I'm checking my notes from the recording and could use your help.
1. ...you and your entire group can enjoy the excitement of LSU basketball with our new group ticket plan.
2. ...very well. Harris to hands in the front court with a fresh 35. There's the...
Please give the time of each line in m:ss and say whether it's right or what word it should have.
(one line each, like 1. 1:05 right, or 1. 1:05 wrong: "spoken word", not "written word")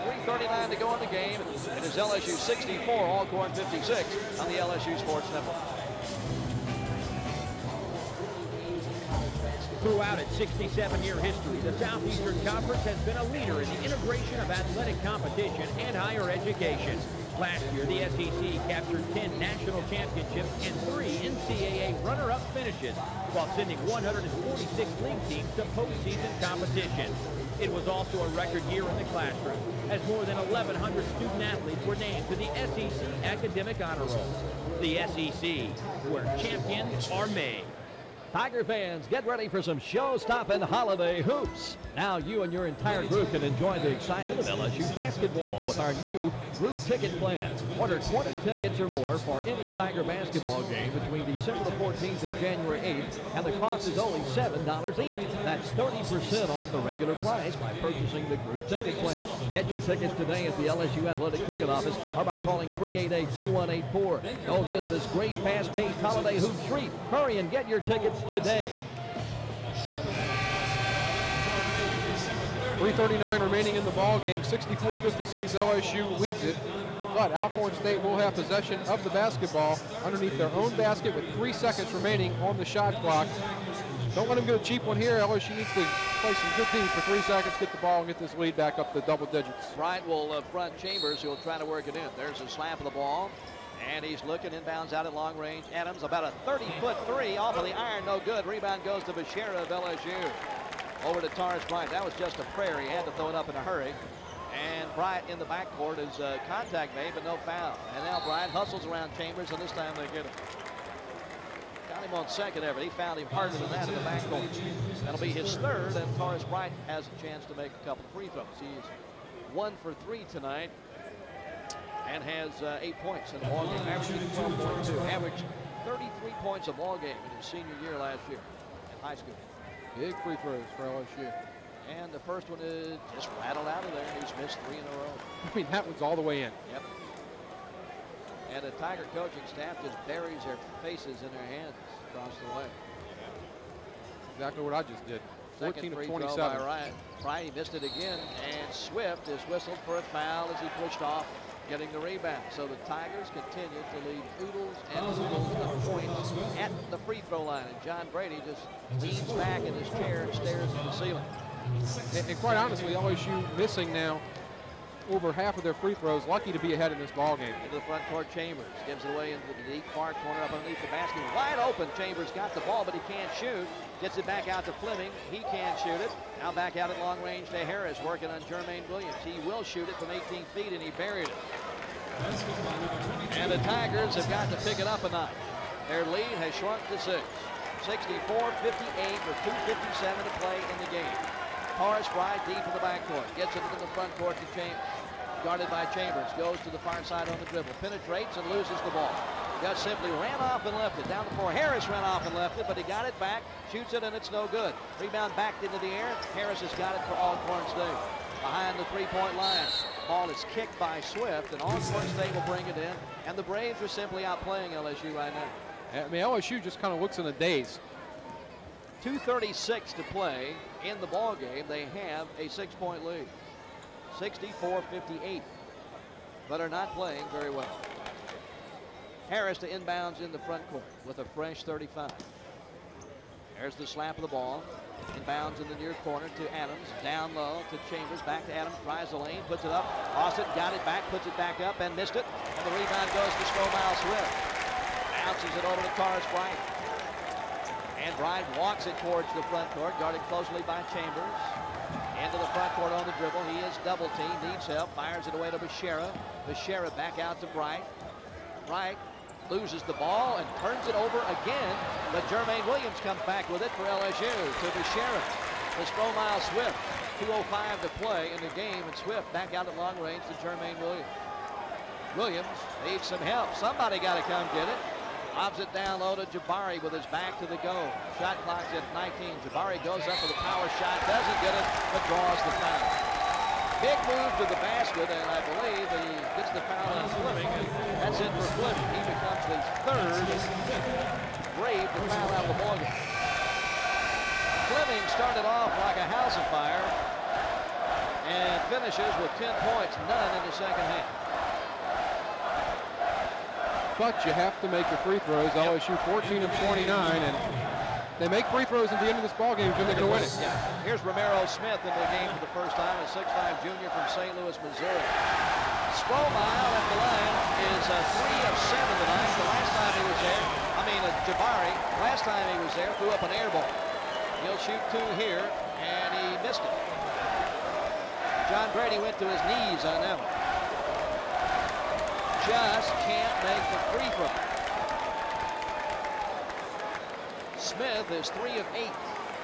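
1. 0:42 right
2. 3:47 wrong: "inbounds", not "hands".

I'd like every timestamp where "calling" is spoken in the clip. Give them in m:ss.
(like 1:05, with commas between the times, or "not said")
1:02.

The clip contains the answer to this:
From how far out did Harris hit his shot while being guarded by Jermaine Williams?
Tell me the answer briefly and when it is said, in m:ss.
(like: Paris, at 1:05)
18 feet, at 3:00.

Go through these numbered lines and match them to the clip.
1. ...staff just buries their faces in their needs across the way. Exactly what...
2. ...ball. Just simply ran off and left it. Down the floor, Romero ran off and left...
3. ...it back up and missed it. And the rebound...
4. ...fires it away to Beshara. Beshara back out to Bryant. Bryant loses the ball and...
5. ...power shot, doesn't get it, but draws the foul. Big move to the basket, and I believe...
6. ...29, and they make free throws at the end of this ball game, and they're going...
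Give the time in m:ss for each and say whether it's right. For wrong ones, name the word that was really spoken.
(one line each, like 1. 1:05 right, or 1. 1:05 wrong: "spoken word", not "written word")
1. 2:19 wrong: "hands", not "needs"
2. 3:18 wrong: "Harris", not "Romero"
3. 4:01 right
4. 4:14 right
5. 4:40 right
6. 5:06 right.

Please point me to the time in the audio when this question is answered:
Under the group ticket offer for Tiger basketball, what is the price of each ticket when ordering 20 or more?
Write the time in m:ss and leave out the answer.
0:54.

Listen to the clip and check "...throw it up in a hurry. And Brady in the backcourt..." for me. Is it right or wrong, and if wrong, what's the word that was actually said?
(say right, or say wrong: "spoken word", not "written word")
wrong: "Bryant", not "Brady".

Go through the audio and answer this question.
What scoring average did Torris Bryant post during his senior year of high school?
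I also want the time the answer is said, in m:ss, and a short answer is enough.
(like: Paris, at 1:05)
33 points, at 2:05.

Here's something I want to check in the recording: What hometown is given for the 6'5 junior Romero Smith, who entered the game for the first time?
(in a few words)
St. Louis, Missouri.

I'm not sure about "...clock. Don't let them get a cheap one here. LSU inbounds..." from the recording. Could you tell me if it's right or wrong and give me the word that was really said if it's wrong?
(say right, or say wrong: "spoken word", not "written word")
wrong: "needs", not "inbounds".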